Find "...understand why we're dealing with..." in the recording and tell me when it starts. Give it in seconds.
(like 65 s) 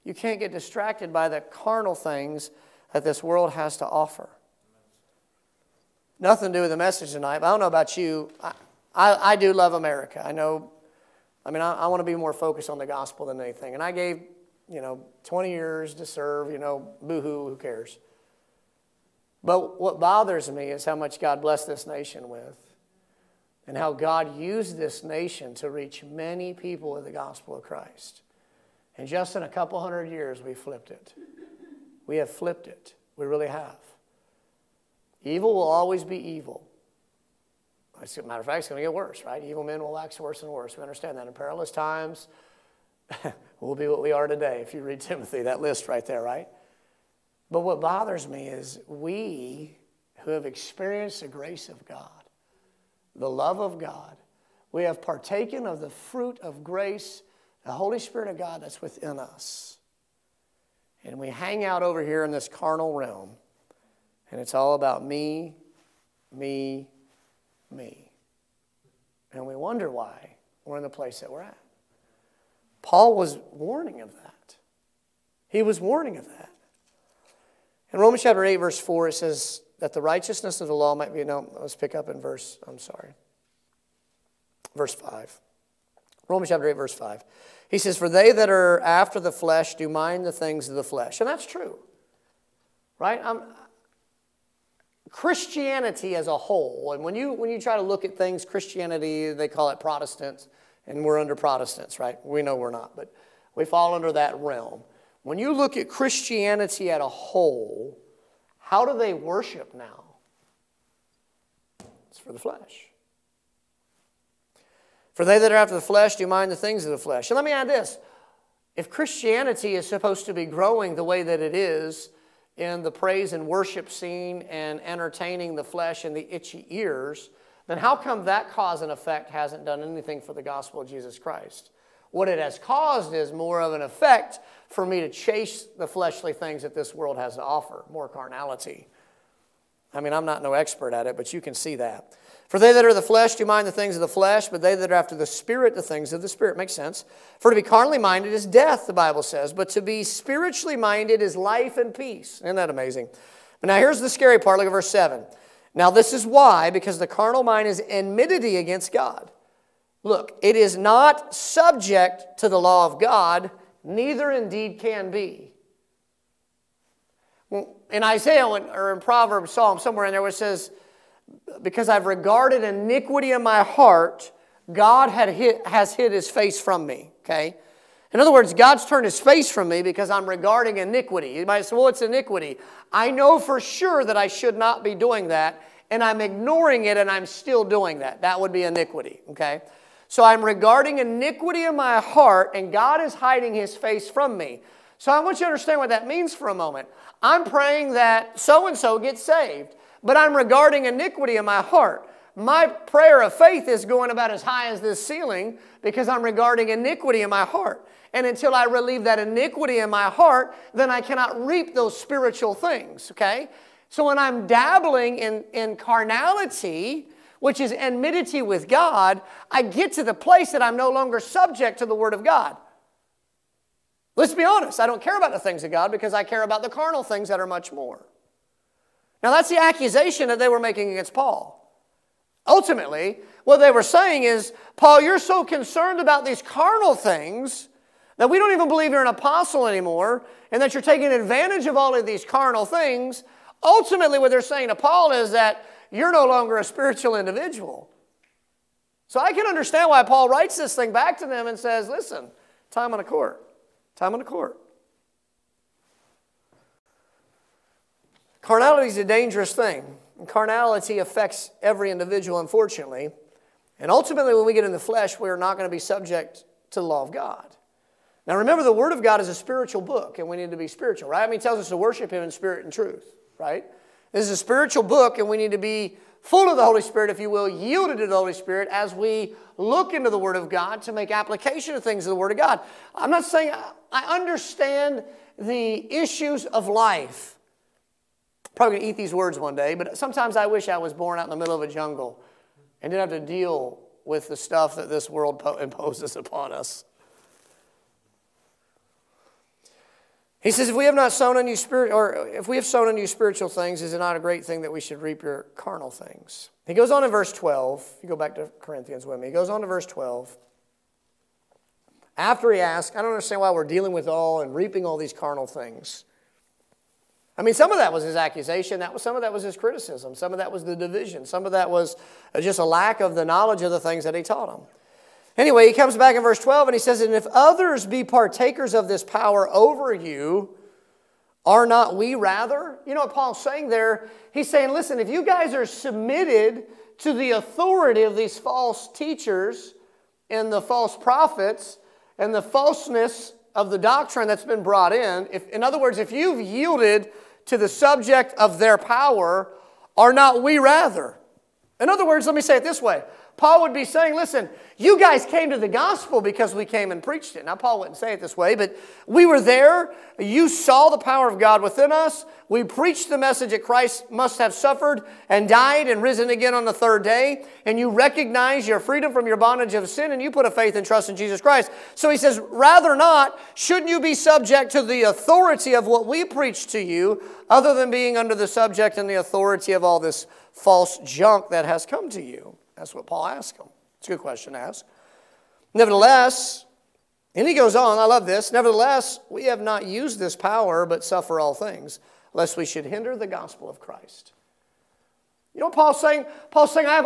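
313 s.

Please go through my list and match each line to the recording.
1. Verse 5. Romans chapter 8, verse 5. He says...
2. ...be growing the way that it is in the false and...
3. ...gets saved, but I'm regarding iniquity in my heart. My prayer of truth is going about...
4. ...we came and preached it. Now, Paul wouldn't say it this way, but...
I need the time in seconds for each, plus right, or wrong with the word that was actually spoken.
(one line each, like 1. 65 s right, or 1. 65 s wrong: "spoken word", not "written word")
1. 84 s right
2. 120 s wrong: "praise", not "false"
3. 198 s wrong: "faith", not "truth"
4. 356 s right.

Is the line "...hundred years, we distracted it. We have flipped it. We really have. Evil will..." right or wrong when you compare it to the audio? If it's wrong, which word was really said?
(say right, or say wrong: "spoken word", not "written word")
wrong: "flipped", not "distracted".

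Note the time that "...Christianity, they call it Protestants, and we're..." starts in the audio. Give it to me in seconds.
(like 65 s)
98 s.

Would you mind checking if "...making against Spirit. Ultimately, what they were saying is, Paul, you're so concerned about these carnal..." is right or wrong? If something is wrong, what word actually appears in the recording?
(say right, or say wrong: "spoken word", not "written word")
wrong: "Paul", not "Spirit".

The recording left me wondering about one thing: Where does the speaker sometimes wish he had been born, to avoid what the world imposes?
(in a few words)
Middle of a jungle.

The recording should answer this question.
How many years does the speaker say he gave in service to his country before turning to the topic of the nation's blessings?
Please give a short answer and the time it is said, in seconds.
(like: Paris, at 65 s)
20, at 15 s.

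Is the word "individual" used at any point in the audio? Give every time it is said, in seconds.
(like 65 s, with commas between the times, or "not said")
247 s, 261 s.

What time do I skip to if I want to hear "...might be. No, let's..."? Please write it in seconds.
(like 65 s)
80 s.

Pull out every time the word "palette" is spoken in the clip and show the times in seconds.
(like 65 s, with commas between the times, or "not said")
not said.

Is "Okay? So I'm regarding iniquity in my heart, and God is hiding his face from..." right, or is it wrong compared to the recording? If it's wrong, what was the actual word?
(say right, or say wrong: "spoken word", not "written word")
right.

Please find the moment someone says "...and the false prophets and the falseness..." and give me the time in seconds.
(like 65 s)
340 s.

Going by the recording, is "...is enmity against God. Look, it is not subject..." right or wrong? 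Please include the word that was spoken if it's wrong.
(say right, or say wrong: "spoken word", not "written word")
right.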